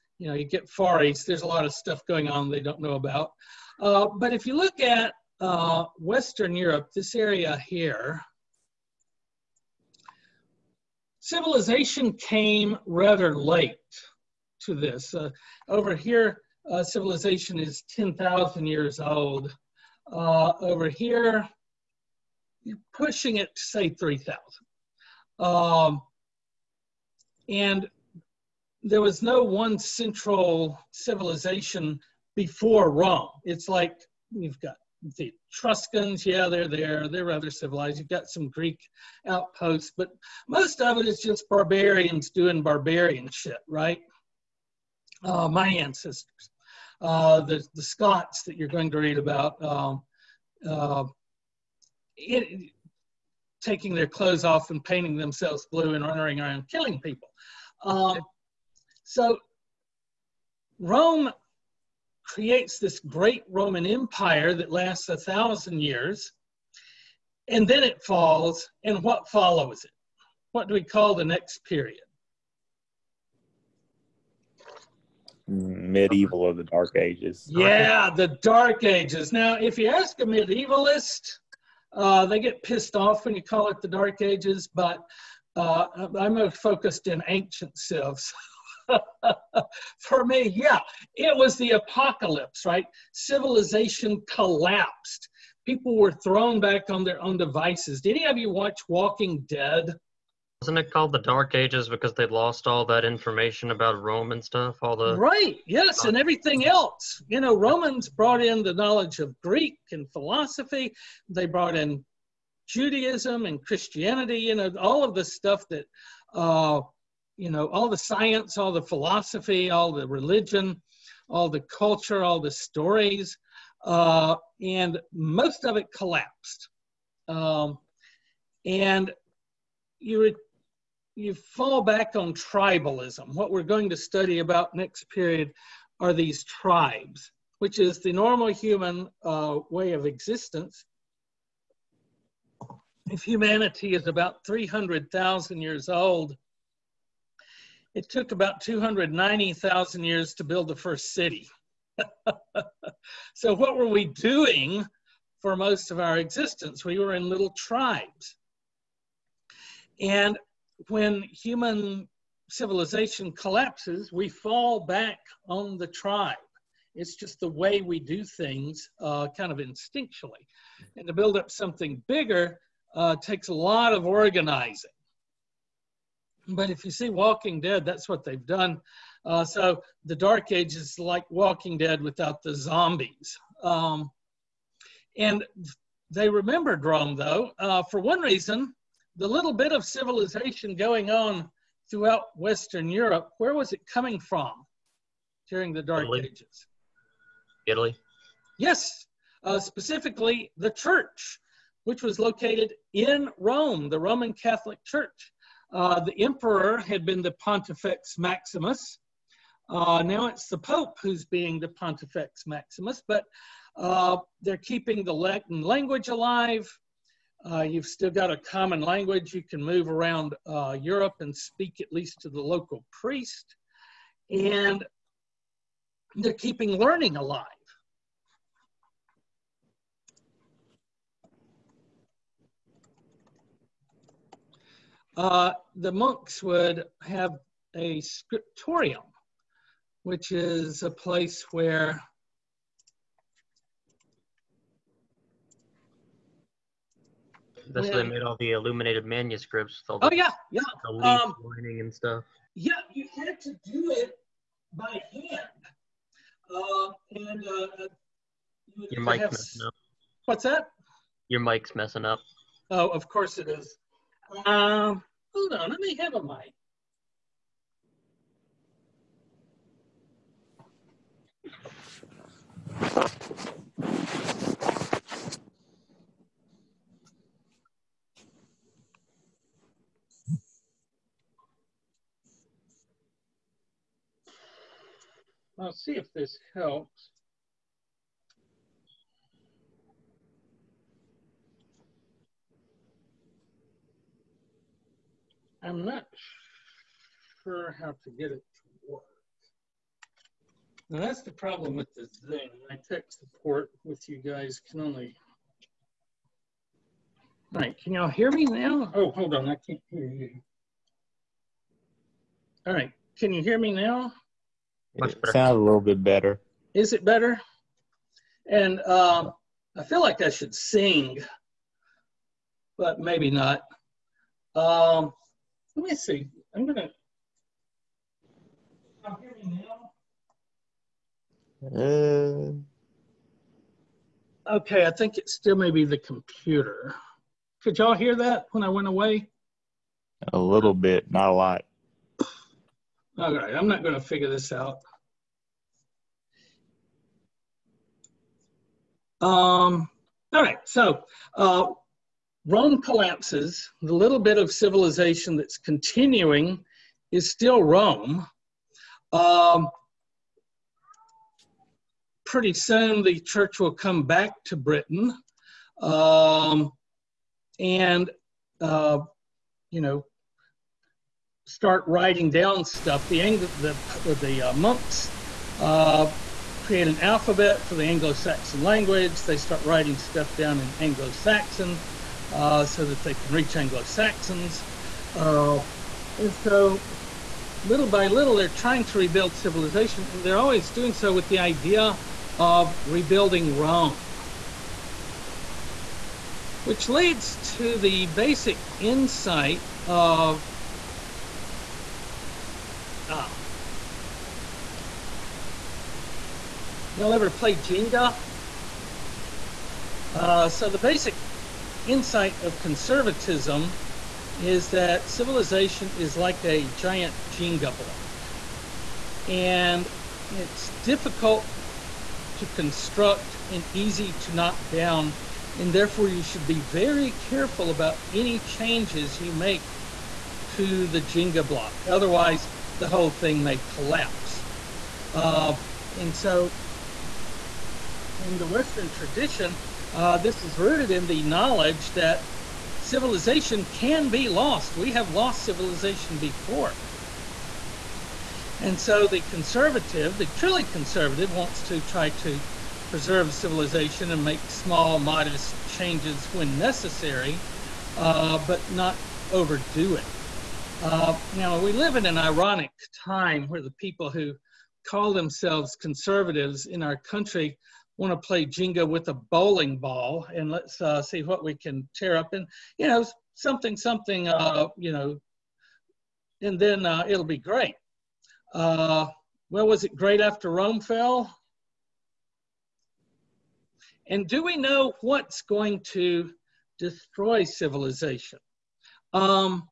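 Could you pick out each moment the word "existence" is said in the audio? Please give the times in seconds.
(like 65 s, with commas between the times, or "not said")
140 s, 156 s.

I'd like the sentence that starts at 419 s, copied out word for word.
And it's difficult to construct and easy to knock down.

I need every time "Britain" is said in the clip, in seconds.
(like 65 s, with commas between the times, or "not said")
364 s.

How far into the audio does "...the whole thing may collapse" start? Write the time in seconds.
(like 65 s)
432 s.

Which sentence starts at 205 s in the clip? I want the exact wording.
Uh, the emperor had been the Pontifex Maximus.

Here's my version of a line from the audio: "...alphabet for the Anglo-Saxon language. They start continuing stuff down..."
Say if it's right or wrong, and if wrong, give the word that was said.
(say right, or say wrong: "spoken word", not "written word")
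wrong: "writing", not "continuing".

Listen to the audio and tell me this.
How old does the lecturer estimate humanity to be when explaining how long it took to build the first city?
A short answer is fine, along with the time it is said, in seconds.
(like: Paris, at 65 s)
300,000 years, at 144 s.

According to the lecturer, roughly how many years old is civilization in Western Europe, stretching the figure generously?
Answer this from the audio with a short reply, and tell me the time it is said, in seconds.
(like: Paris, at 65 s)
3,000, at 23 s.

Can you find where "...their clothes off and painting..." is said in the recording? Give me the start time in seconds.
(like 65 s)
53 s.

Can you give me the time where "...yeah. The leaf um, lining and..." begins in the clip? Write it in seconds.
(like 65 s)
250 s.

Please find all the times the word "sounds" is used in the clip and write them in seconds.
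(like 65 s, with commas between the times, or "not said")
315 s.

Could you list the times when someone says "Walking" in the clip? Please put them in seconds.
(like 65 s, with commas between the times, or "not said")
98 s, 177 s, 181 s.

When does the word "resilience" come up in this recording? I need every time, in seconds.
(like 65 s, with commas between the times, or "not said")
not said.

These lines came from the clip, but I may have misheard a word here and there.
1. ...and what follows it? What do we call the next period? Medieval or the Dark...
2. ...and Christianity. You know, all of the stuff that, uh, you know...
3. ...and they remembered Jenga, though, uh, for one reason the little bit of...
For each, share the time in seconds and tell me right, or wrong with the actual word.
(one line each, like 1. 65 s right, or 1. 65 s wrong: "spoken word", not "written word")
1. 68 s right
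2. 113 s right
3. 185 s wrong: "Rome", not "Jenga".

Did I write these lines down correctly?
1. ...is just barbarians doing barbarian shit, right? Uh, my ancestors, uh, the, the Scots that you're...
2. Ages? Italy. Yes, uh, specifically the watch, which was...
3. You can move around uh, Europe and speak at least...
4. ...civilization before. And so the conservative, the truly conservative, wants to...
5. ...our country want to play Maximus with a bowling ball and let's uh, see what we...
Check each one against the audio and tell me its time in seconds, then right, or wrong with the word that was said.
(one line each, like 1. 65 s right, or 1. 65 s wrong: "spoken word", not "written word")
1. 41 s right
2. 196 s wrong: "church", not "watch"
3. 219 s right
4. 445 s right
5. 466 s wrong: "Jenga", not "Maximus".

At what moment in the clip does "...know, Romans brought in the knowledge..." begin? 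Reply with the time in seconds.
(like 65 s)
107 s.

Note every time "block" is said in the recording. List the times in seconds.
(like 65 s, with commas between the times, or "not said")
417 s, 431 s.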